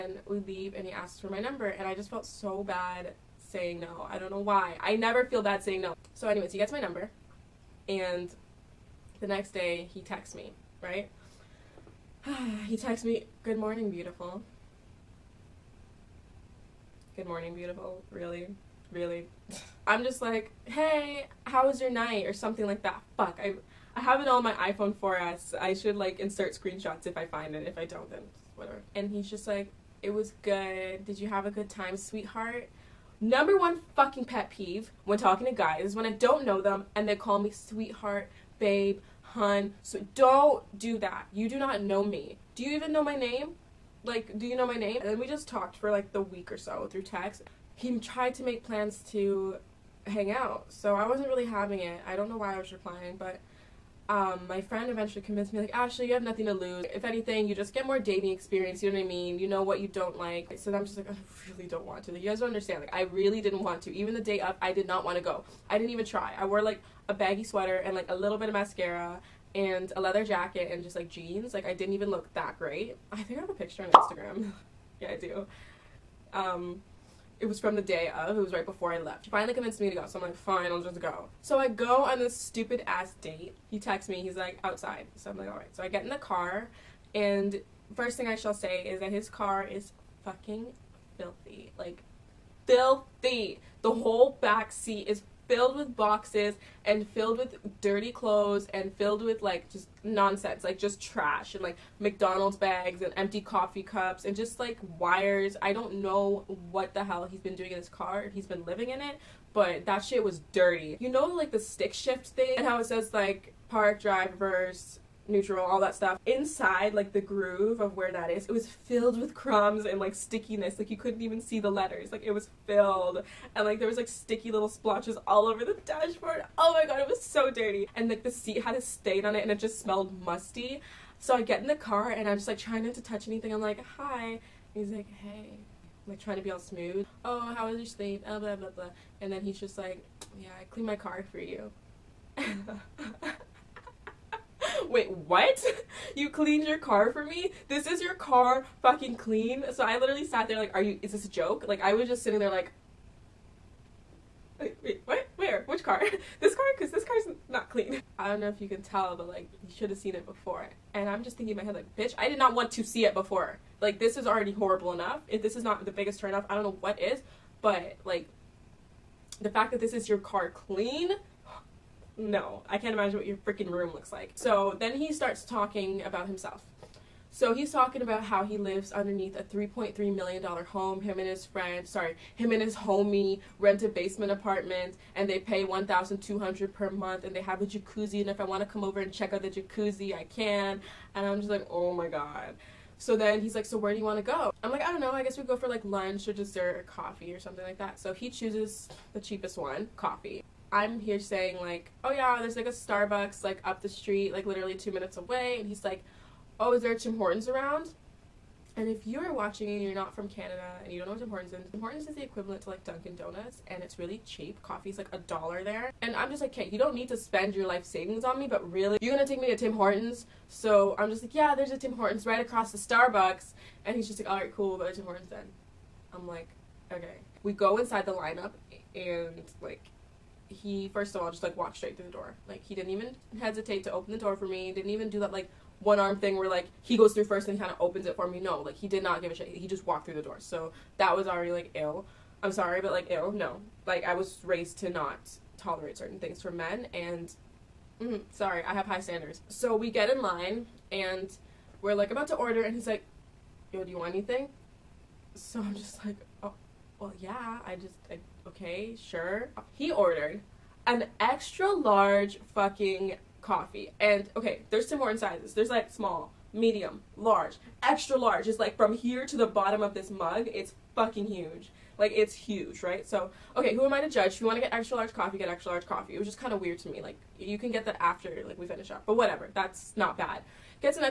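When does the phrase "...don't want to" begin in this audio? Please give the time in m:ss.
1:01.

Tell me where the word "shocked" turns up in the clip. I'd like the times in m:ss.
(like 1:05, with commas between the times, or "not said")
not said.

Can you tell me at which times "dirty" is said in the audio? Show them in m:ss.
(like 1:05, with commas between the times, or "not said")
1:37, 1:50, 2:07.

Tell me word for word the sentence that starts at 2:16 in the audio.
I'm like trying to be all smooth.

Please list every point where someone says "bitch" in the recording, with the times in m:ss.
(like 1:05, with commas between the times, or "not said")
2:41.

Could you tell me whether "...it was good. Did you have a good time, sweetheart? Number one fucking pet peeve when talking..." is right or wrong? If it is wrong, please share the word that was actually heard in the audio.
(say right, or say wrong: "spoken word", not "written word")
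right.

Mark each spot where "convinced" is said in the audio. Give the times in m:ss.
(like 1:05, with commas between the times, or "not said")
0:55, 1:19.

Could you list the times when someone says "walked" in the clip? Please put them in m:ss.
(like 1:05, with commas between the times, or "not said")
3:51, 3:59.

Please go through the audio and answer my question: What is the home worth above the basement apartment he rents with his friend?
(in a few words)
$3.3 million.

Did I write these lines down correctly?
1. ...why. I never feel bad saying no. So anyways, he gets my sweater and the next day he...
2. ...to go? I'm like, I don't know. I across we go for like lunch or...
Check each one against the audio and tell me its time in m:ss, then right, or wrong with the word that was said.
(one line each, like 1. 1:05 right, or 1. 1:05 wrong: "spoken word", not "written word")
1. 0:04 wrong: "number", not "sweater"
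2. 3:14 wrong: "guess", not "across".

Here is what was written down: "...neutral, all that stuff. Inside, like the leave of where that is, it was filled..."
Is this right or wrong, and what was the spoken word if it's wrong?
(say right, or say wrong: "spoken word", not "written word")
wrong: "groove", not "leave".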